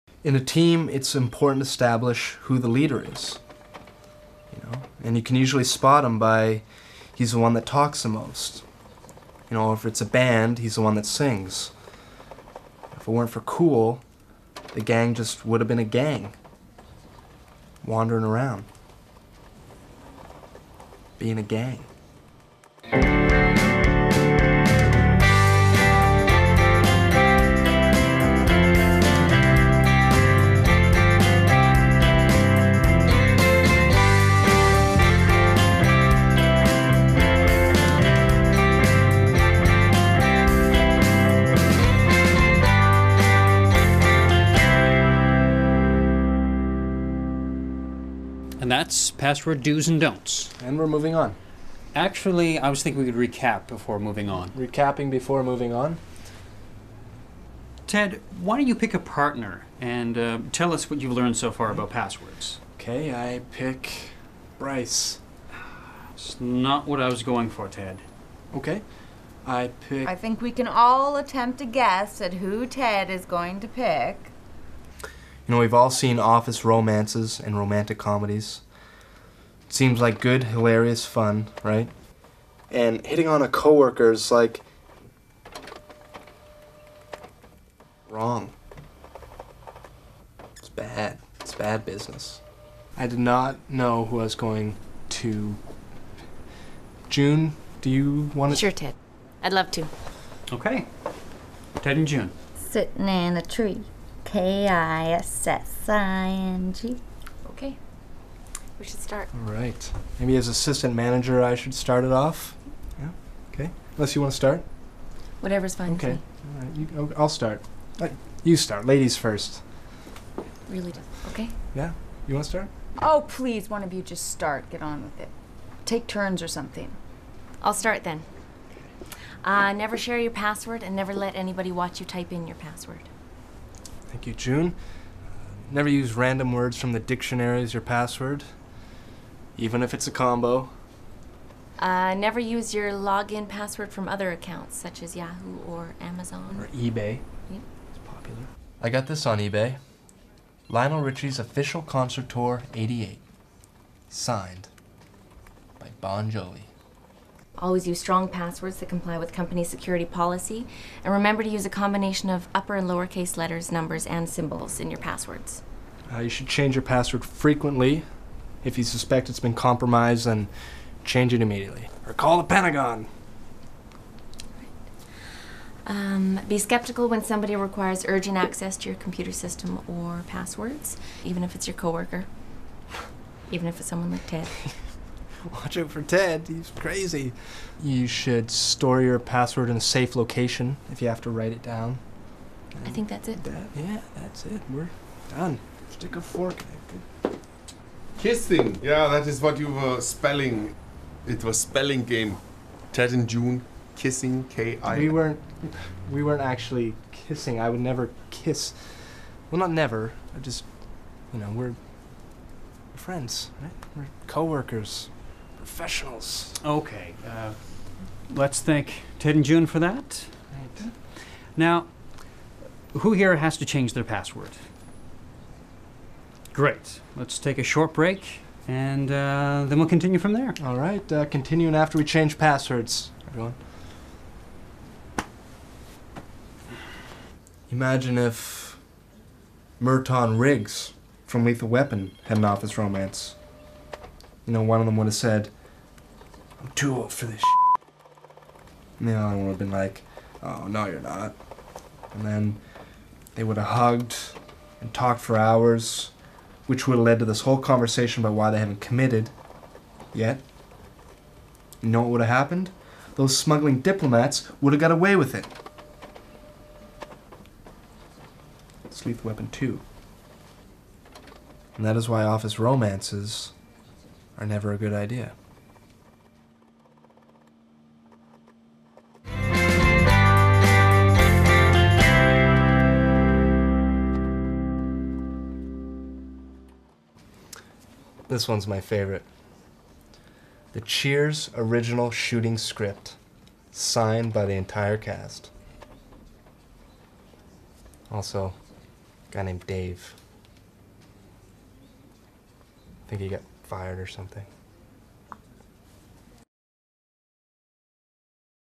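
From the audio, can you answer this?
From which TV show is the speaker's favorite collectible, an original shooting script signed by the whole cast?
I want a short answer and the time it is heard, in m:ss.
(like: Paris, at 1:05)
Cheers, at 4:50.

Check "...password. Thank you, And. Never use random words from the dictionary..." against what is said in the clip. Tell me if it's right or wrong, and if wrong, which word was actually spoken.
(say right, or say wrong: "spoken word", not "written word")
wrong: "June", not "And".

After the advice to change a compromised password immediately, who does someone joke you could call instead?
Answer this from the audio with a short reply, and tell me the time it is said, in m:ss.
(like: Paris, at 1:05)
The Pentagon, at 2:52.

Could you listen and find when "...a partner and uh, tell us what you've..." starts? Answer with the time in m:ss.
0:58.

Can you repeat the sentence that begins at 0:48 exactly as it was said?
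And that's password do's and don'ts.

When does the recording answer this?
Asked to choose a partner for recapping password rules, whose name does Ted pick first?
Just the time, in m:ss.
1:04.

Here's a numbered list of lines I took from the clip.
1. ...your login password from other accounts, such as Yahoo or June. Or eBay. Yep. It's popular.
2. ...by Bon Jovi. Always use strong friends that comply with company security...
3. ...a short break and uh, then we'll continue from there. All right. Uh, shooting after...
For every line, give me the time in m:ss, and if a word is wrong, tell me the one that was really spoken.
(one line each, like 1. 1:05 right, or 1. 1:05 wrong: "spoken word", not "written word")
1. 2:22 wrong: "Amazon", not "June"
2. 2:35 wrong: "passwords", not "friends"
3. 3:47 wrong: "continuing", not "shooting".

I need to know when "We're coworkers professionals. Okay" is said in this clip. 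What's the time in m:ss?
3:33.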